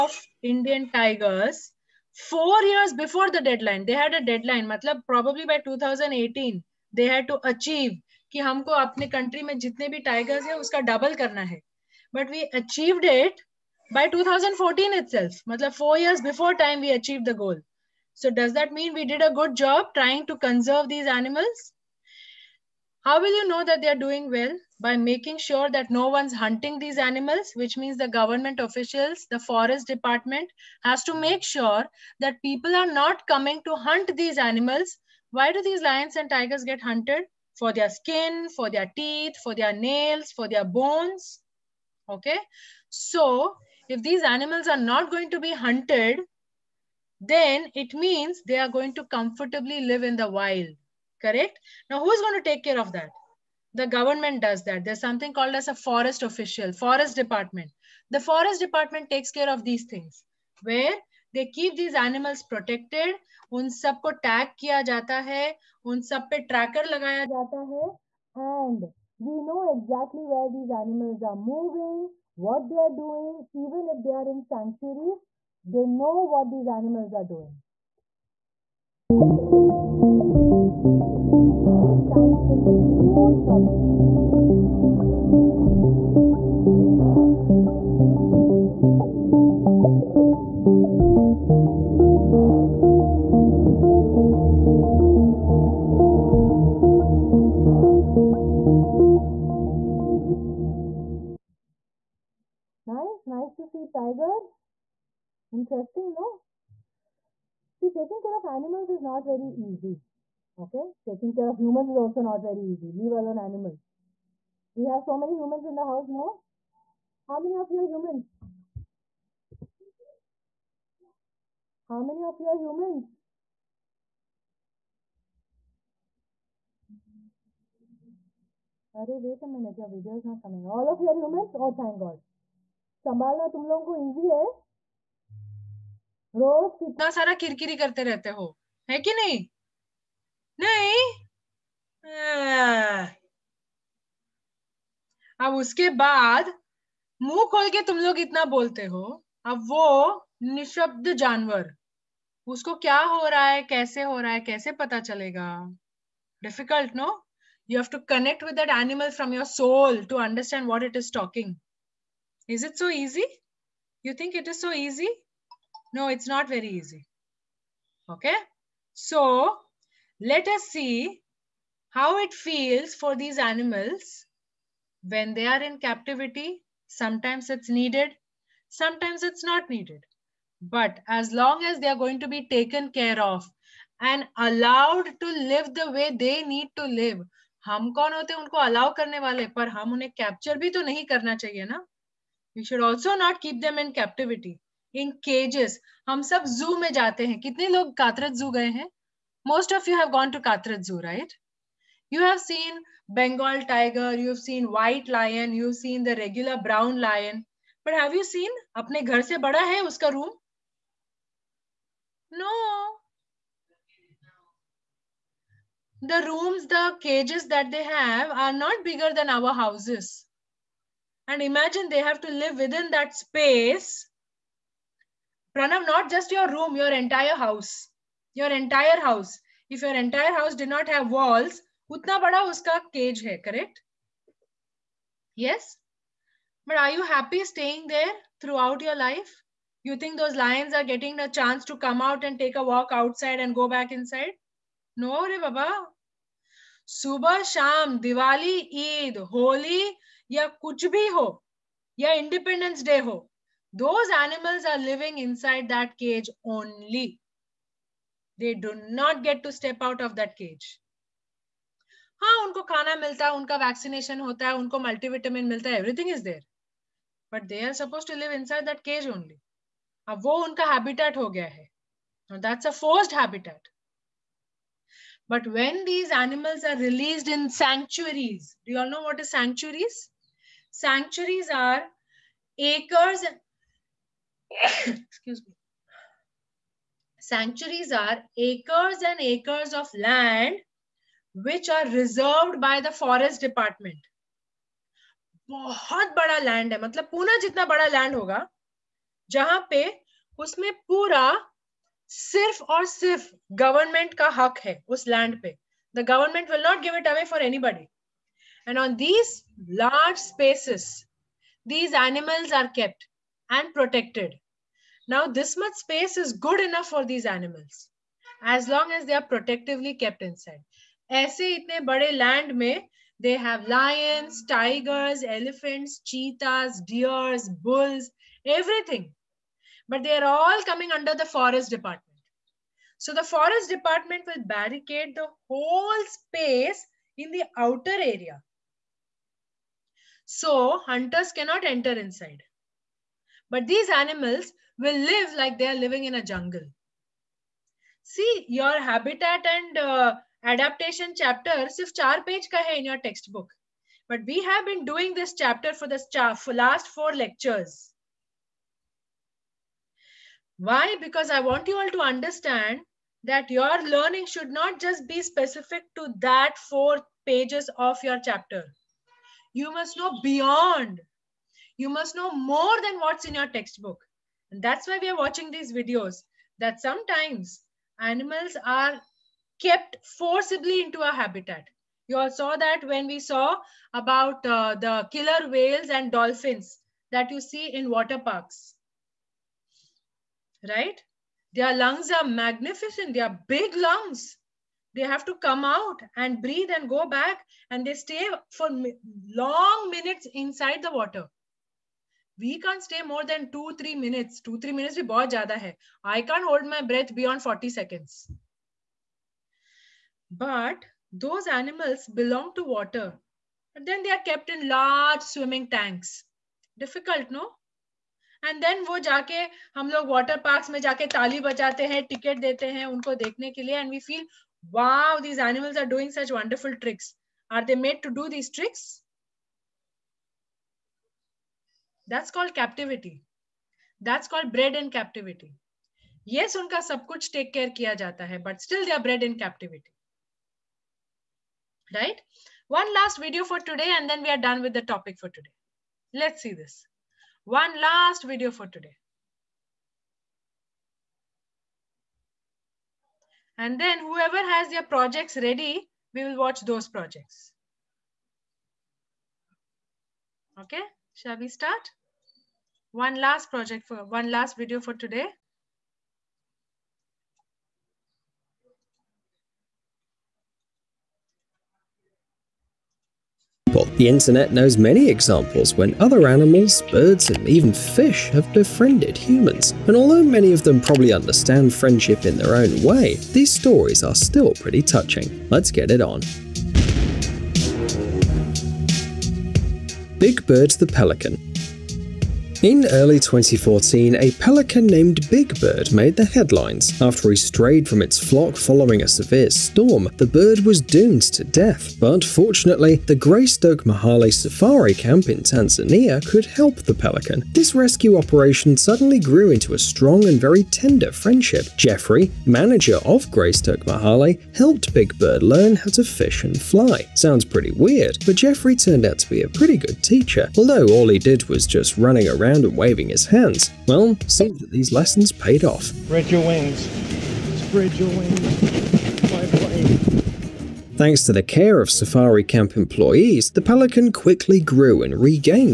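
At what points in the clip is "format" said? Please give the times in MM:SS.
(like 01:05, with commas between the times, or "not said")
not said.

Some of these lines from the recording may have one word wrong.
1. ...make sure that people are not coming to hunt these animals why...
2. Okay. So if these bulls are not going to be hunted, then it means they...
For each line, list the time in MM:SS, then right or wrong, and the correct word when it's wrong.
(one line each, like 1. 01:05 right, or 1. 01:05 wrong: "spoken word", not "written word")
1. 00:31 right
2. 00:42 wrong: "animals", not "bulls".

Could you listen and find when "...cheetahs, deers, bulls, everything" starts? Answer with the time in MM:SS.
05:25.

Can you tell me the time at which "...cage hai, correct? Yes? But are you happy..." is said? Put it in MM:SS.
03:52.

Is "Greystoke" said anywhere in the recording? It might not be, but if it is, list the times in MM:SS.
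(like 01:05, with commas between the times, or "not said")
08:23, 08:33.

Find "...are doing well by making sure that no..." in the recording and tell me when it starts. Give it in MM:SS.
00:23.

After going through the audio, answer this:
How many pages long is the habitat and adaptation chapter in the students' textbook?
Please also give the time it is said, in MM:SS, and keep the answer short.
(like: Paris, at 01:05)
4, at 05:51.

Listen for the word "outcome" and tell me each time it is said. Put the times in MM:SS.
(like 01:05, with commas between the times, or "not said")
not said.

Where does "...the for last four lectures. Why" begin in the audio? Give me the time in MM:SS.
05:55.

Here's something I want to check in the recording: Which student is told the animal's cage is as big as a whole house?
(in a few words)
Pranav.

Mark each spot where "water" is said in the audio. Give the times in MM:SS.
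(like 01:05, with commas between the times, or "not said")
06:27, 06:40, 06:52.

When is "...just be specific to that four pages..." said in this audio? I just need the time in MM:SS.
06:04.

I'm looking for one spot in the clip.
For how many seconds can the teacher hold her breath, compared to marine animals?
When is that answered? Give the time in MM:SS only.
06:47.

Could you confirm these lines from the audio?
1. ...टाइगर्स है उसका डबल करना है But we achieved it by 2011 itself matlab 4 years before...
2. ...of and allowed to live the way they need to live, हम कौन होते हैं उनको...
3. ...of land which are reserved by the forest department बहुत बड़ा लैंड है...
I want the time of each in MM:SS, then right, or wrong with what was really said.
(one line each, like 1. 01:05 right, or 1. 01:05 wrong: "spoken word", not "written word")
1. 00:10 wrong: "2014", not "2011"
2. 03:03 right
3. 04:49 right.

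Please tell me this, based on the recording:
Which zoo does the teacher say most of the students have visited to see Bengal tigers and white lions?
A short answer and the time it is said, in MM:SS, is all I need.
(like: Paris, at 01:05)
Katraj Zoo, at 03:20.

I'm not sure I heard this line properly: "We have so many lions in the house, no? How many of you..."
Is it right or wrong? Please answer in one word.
wrong.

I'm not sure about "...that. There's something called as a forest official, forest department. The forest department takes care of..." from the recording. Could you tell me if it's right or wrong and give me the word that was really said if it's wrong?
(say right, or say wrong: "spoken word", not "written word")
right.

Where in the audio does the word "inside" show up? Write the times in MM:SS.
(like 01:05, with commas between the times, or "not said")
04:03, 05:20, 05:41, 06:40.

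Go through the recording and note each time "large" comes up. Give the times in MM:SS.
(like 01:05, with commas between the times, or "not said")
05:09, 06:54.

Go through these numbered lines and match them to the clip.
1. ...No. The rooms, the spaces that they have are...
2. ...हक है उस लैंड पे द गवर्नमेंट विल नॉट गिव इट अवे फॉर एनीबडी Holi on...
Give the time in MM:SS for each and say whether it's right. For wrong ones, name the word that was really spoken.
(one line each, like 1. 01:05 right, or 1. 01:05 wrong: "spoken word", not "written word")
1. 03:32 wrong: "cages", not "spaces"
2. 05:04 wrong: "And", not "Holi".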